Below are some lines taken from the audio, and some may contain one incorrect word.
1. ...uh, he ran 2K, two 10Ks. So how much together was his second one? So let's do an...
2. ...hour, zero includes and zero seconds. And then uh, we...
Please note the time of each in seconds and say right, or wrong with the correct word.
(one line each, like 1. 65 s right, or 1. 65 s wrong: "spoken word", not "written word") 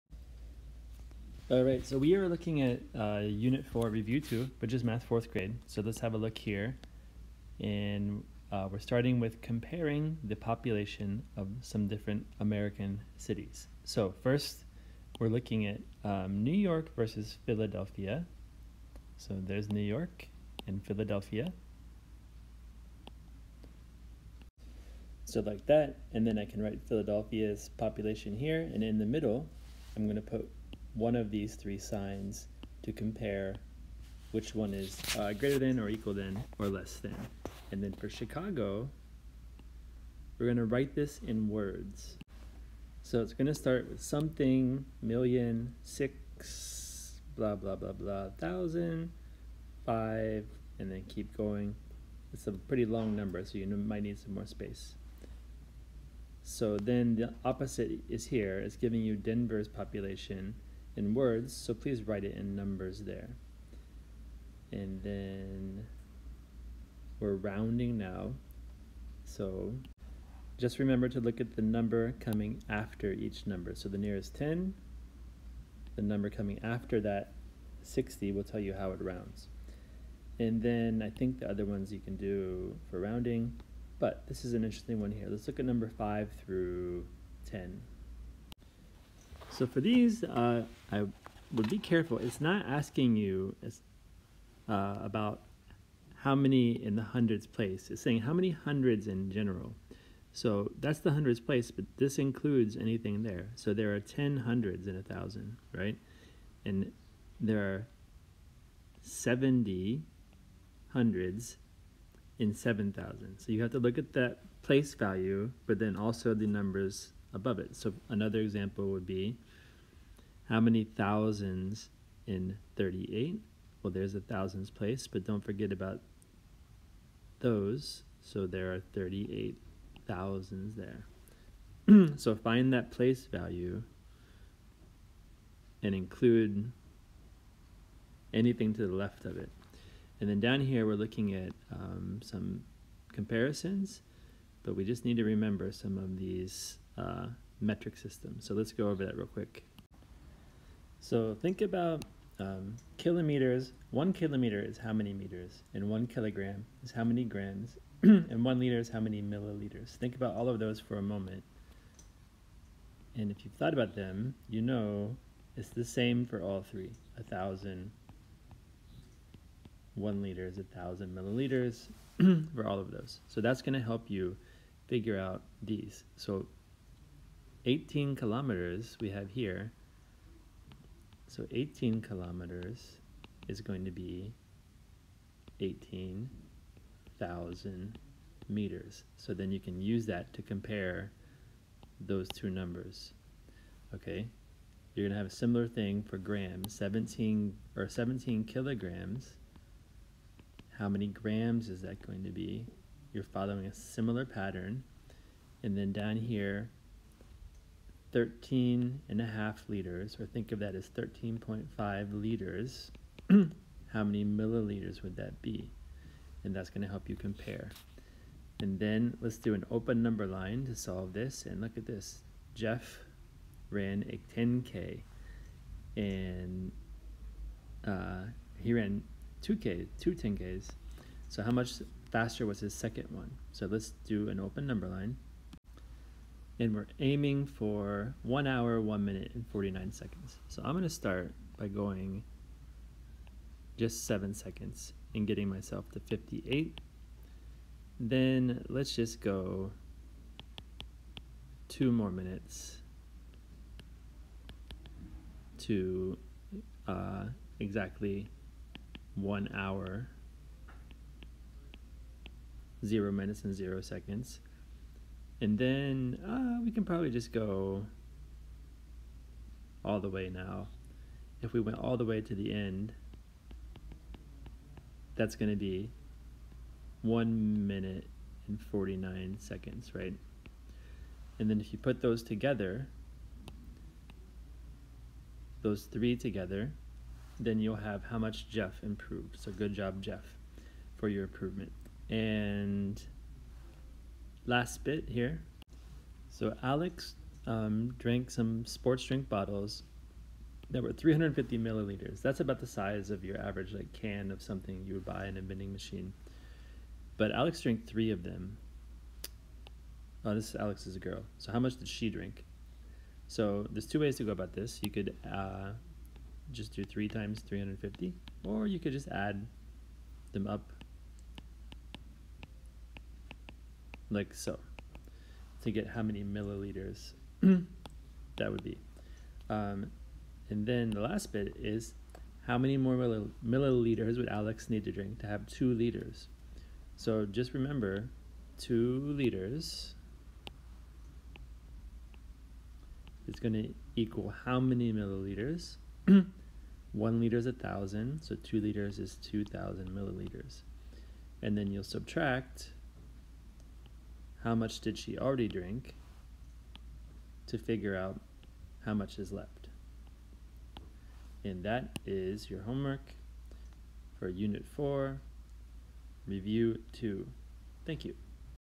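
1. 227 s wrong: "faster", not "together"
2. 259 s wrong: "minutes", not "includes".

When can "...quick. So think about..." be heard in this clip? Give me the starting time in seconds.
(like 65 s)
149 s.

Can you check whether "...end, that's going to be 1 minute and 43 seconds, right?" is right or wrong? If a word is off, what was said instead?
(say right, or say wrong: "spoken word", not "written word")
wrong: "49", not "43".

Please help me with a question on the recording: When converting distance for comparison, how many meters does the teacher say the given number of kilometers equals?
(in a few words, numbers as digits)
18,000.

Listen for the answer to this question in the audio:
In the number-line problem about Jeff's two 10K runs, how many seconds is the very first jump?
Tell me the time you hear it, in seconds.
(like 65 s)
244 s.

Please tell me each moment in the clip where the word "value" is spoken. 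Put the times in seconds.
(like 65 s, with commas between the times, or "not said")
114 s, 133 s.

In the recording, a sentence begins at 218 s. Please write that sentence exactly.
And then let's do an open number line to solve this.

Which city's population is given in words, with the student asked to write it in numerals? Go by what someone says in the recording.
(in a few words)
Denver.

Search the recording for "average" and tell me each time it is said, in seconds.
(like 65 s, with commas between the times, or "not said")
303 s.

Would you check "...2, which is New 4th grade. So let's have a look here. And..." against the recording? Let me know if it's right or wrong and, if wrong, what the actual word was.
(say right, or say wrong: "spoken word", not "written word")
wrong: "Math", not "New".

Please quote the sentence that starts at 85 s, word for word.
Let's look at number 5 through 10.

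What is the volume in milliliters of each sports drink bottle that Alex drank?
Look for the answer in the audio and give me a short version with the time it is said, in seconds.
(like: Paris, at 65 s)
350 milliliters, at 300 s.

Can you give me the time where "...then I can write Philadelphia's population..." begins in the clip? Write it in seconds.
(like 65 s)
26 s.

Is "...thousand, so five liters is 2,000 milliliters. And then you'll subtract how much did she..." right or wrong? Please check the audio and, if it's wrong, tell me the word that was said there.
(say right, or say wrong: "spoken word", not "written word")
wrong: "two", not "five".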